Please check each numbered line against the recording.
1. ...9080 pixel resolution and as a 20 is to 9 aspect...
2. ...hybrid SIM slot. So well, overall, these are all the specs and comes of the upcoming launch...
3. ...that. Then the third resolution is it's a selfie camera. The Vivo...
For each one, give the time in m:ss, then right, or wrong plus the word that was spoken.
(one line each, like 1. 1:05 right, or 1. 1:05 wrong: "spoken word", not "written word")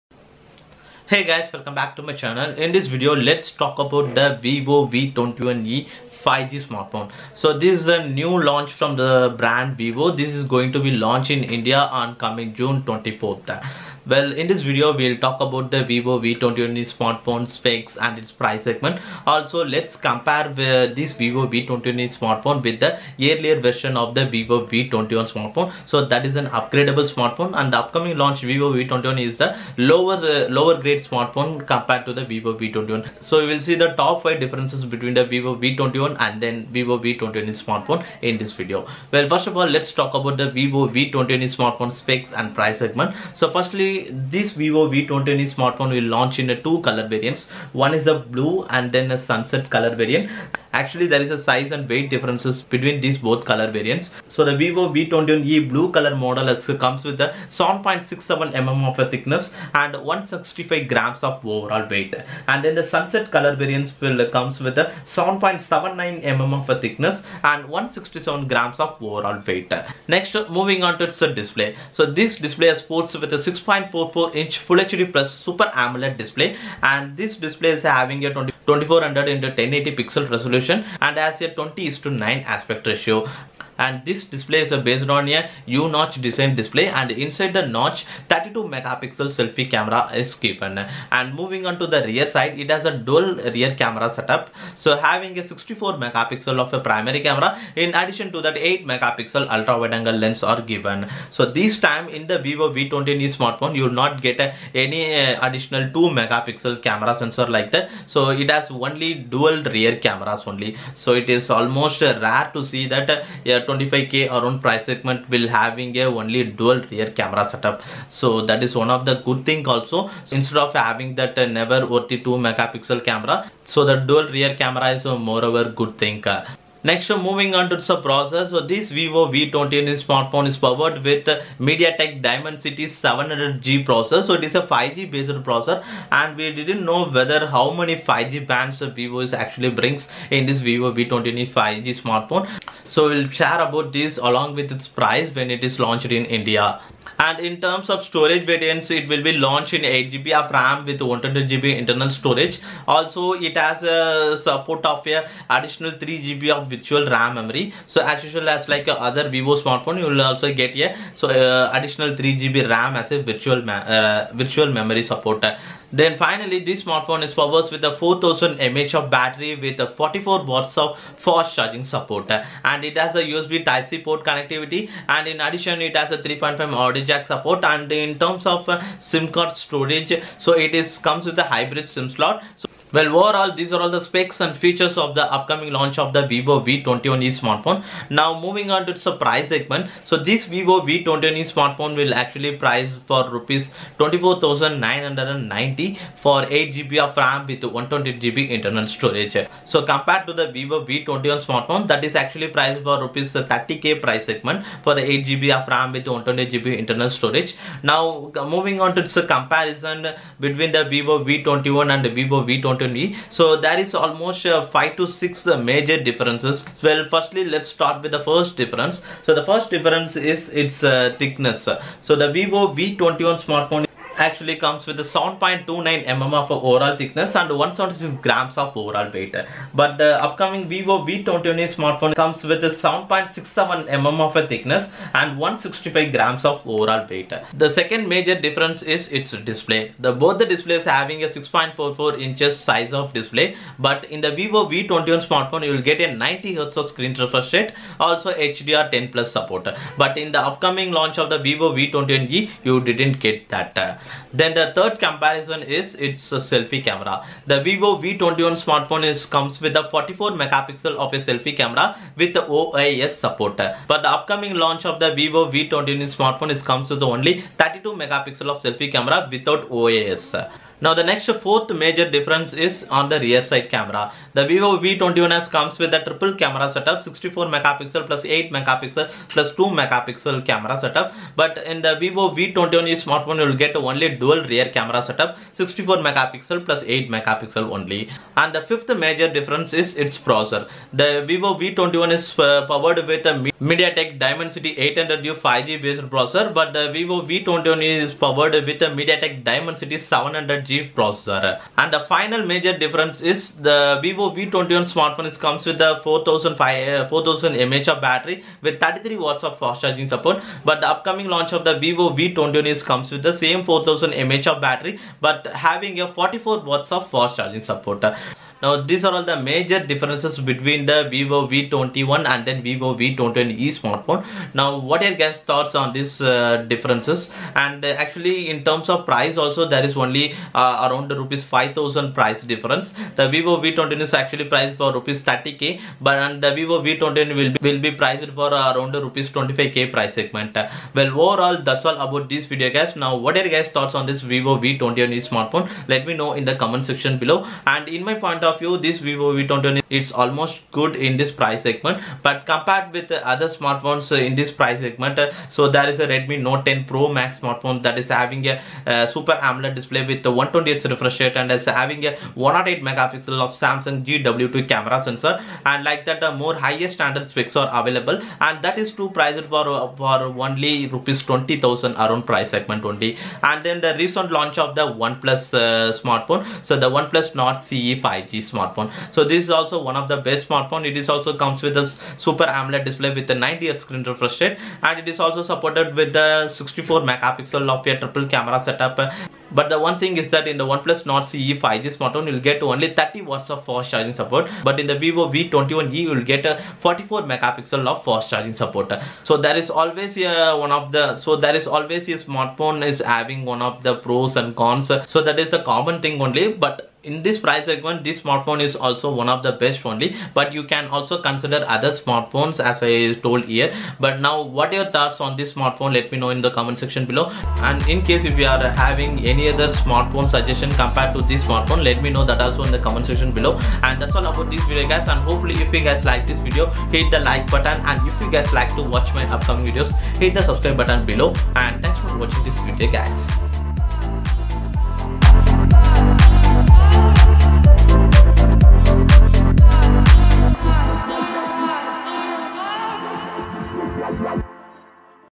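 1. 1:19 wrong: "1080", not "9080"
2. 3:01 wrong: "features", not "comes"
3. 4:13 wrong: "comparison", not "resolution".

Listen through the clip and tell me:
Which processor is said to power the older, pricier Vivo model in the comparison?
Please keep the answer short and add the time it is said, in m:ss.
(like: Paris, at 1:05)
Dimensity 800U, at 4:53.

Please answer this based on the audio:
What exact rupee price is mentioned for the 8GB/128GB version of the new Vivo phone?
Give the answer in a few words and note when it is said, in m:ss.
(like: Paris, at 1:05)
24,990, at 3:13.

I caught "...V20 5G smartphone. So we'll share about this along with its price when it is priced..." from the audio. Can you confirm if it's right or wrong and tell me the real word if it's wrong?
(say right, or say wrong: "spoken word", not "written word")
wrong: "launched", not "priced".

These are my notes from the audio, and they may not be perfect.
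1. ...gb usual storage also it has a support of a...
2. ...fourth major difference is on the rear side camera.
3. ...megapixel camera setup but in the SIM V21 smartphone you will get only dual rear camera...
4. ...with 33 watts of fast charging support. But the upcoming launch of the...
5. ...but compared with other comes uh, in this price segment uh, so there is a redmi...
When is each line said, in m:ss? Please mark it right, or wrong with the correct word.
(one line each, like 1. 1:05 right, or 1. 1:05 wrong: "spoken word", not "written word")
1. 2:31 wrong: "internal", not "usual"
2. 4:31 right
3. 4:39 wrong: "Vivo", not "SIM"
4. 5:08 right
5. 5:52 wrong: "smartphones", not "comes".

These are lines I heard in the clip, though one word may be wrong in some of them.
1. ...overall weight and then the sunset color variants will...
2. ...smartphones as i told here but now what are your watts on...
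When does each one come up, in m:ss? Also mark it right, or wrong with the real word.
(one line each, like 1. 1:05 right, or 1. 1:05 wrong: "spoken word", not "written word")
1. 1:01 right
2. 6:51 wrong: "thoughts", not "watts".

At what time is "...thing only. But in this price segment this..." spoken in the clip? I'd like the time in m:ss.
6:46.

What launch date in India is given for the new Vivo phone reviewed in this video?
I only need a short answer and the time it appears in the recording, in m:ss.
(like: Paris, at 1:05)
June 24th, at 0:12.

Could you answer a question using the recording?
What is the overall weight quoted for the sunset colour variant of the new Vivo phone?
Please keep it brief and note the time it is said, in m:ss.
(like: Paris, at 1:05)
167 grams, at 1:07.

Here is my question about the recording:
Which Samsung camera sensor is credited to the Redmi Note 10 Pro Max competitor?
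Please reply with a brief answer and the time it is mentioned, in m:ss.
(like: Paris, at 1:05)
GW2, at 6:03.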